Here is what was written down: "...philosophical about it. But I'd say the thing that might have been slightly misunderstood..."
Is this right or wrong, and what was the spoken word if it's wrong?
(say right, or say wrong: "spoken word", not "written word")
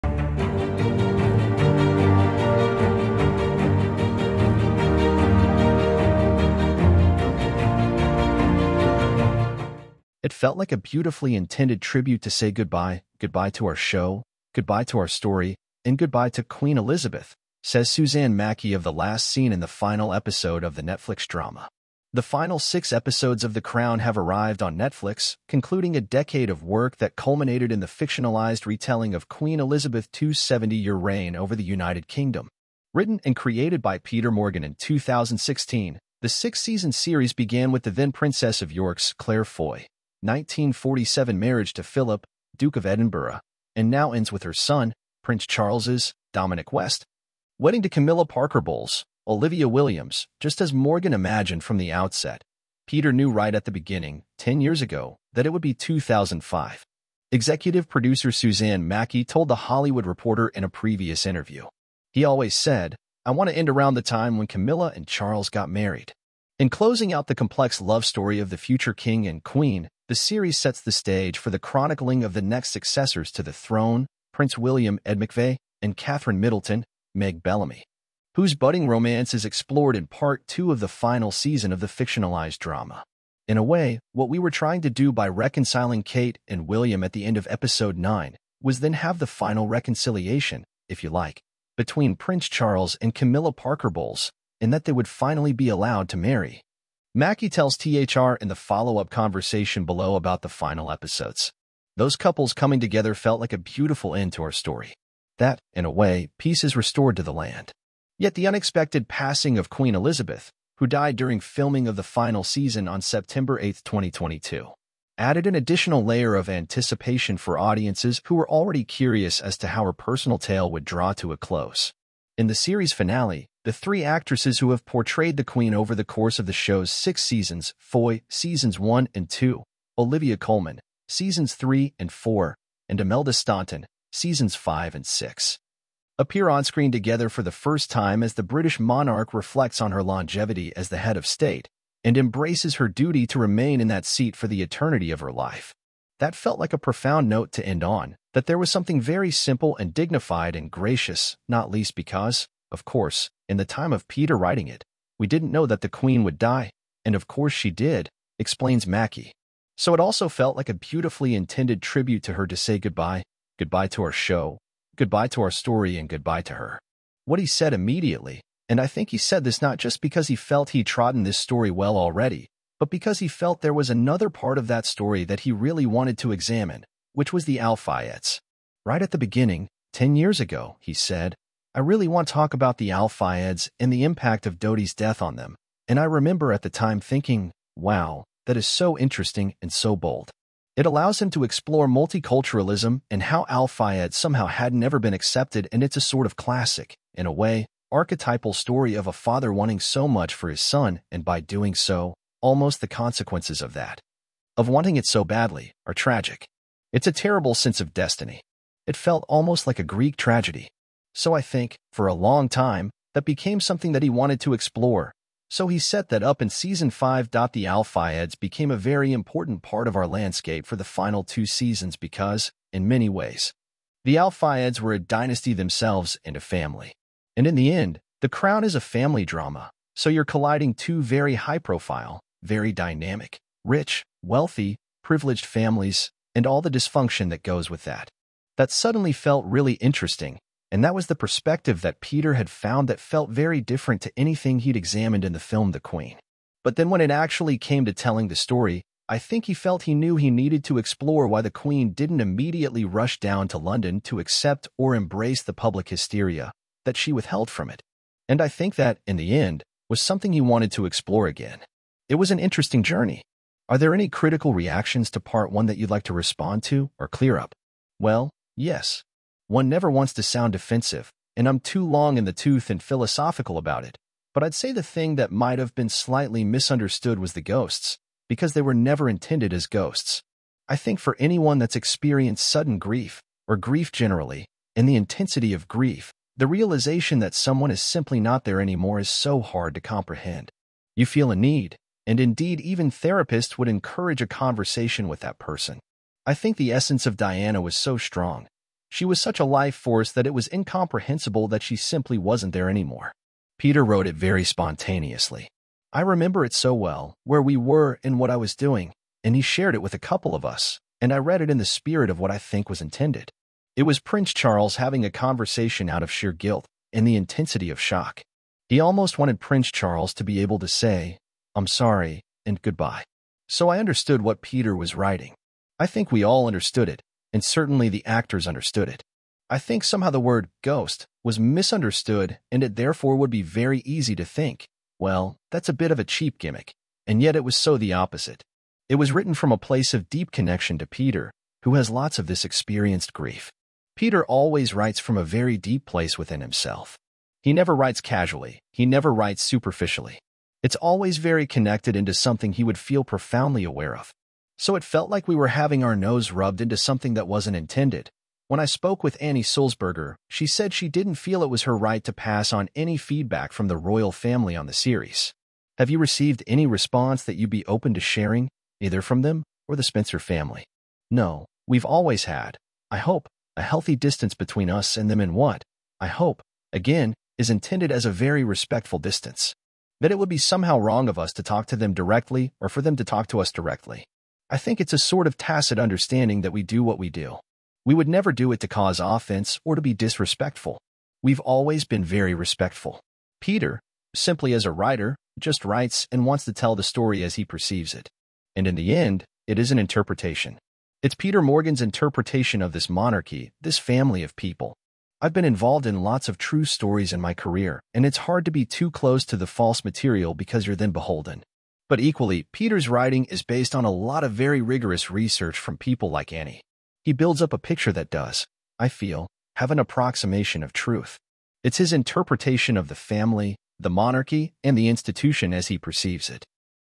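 right.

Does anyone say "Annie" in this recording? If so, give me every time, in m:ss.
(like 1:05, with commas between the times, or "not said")
5:59, 6:56.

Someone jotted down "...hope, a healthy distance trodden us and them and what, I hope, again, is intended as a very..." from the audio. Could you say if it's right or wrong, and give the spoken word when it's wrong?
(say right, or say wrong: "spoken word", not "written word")
wrong: "between", not "trodden".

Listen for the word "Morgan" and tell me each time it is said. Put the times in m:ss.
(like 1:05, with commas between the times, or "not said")
0:34, 0:50, 6:41.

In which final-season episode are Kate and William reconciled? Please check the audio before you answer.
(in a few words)
Episode 9.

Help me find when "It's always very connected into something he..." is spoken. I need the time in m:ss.
5:50.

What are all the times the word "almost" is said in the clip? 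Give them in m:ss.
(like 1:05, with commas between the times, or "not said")
3:22, 3:29, 5:18.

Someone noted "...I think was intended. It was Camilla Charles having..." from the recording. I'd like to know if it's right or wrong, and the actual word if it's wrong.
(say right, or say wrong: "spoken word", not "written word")
wrong: "Prince", not "Camilla".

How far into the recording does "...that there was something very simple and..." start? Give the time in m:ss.
2:28.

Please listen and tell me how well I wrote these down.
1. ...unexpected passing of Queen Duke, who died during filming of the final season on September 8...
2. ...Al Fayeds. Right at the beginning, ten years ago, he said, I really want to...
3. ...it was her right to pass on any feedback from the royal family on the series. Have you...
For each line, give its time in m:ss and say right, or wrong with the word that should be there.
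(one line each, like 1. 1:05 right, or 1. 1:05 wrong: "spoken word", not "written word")
1. 1:48 wrong: "Elizabeth", not "Duke"
2. 2:57 right
3. 6:01 right.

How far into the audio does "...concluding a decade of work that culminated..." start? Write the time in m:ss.
0:25.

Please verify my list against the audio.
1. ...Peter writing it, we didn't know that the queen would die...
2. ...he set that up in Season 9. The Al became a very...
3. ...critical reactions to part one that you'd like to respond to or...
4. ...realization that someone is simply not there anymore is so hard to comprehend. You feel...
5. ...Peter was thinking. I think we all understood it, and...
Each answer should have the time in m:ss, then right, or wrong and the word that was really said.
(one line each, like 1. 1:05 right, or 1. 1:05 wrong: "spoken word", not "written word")
1. 2:34 right
2. 3:35 wrong: "5", not "9"
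3. 4:24 right
4. 4:46 right
5. 5:24 wrong: "writing", not "thinking".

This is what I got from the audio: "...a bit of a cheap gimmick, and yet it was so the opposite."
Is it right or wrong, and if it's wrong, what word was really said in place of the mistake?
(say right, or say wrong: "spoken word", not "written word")
right.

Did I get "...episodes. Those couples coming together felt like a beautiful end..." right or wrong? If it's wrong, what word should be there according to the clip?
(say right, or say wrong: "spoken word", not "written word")
right.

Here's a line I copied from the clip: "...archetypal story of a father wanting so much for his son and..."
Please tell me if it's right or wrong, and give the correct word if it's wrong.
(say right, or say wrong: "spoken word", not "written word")
right.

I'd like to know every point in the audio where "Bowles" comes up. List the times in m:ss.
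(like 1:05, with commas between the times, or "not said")
0:48, 1:33.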